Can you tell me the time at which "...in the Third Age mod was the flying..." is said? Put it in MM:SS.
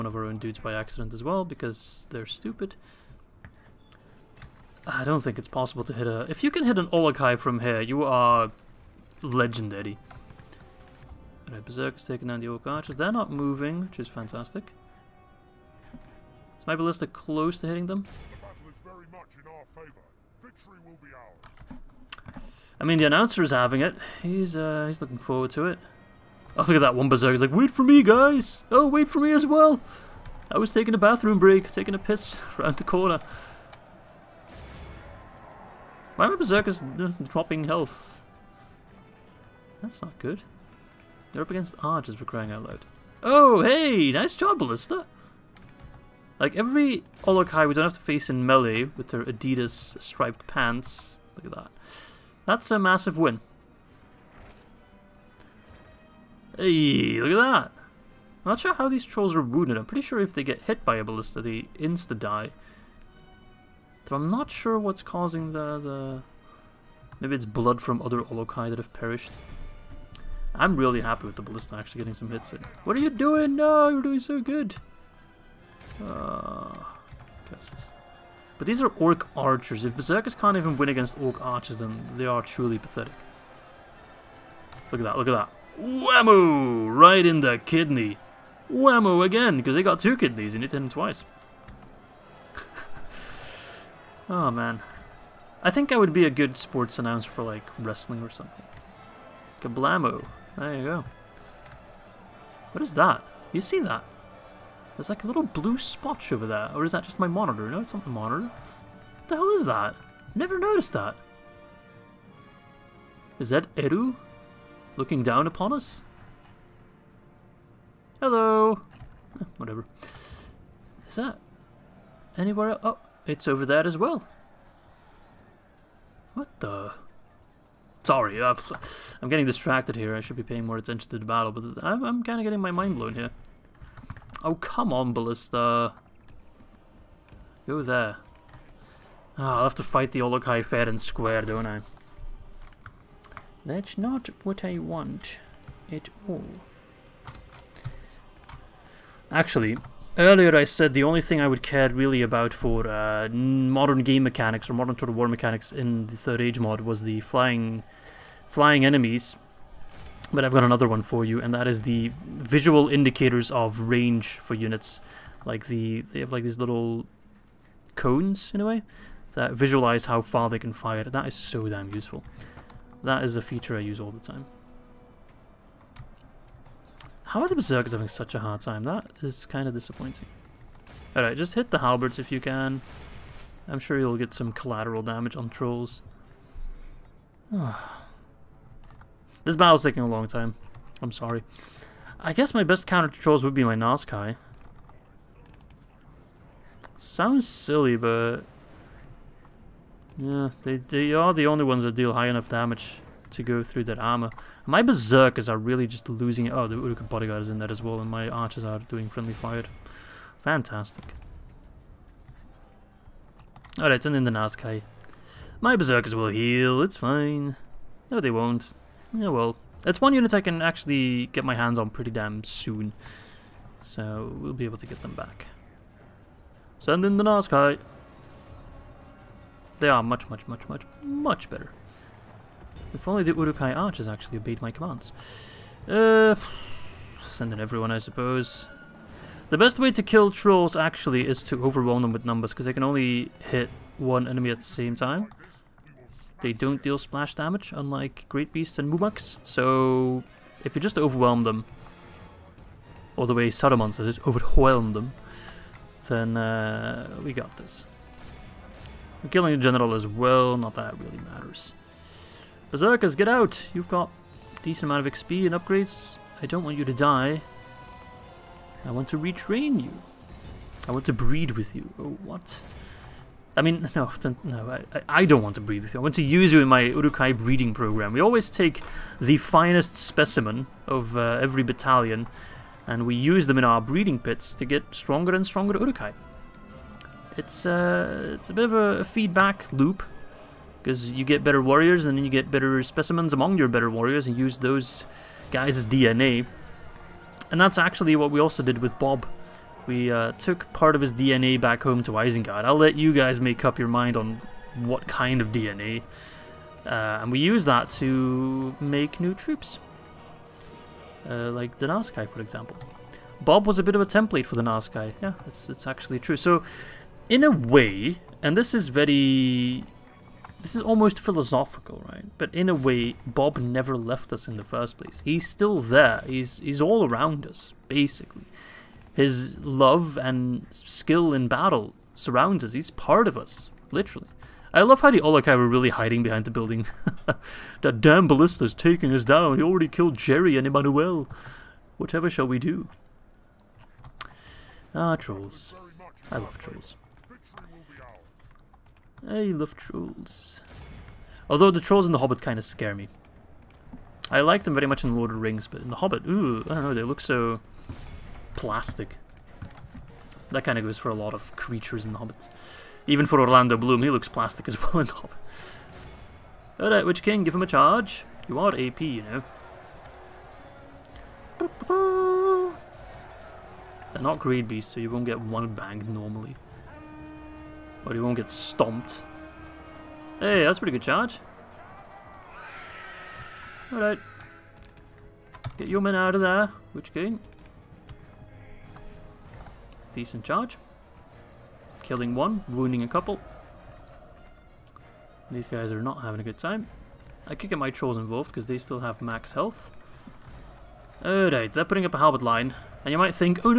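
02:35.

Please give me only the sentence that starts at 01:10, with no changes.
I'm really happy with the Ballista actually getting some hits in.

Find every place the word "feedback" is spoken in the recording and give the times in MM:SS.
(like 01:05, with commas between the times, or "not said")
04:49.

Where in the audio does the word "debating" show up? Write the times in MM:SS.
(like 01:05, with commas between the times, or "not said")
not said.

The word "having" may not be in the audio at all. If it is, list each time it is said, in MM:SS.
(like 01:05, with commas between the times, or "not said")
00:23, 02:57, 06:36.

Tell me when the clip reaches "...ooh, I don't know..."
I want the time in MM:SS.
05:56.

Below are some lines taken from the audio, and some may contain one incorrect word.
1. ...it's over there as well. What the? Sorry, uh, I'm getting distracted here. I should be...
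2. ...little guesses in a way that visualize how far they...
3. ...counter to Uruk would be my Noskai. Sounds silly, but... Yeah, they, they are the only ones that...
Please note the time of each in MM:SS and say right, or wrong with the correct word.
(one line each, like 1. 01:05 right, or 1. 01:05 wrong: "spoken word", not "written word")
1. 02:03 right
2. 02:46 wrong: "cones", not "guesses"
3. 03:12 wrong: "Trolls", not "Uruk".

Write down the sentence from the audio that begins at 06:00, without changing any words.
That kind of goes for a lot of creatures in The Hobbit.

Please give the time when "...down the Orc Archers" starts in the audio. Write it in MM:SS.
00:12.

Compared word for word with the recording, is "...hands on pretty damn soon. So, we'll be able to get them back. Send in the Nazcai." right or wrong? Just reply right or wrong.
right.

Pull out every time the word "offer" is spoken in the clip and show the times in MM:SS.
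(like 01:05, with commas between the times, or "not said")
not said.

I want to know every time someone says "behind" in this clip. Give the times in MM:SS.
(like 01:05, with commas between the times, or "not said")
05:36.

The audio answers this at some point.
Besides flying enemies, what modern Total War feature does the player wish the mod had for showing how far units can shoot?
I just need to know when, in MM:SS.
02:42.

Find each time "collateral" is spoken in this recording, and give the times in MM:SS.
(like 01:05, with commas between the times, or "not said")
03:04.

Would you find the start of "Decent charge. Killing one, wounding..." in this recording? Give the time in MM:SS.
06:30.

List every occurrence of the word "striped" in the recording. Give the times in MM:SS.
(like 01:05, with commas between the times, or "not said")
00:50.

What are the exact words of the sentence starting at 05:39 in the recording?
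He already killed Jerry and Emmanuel.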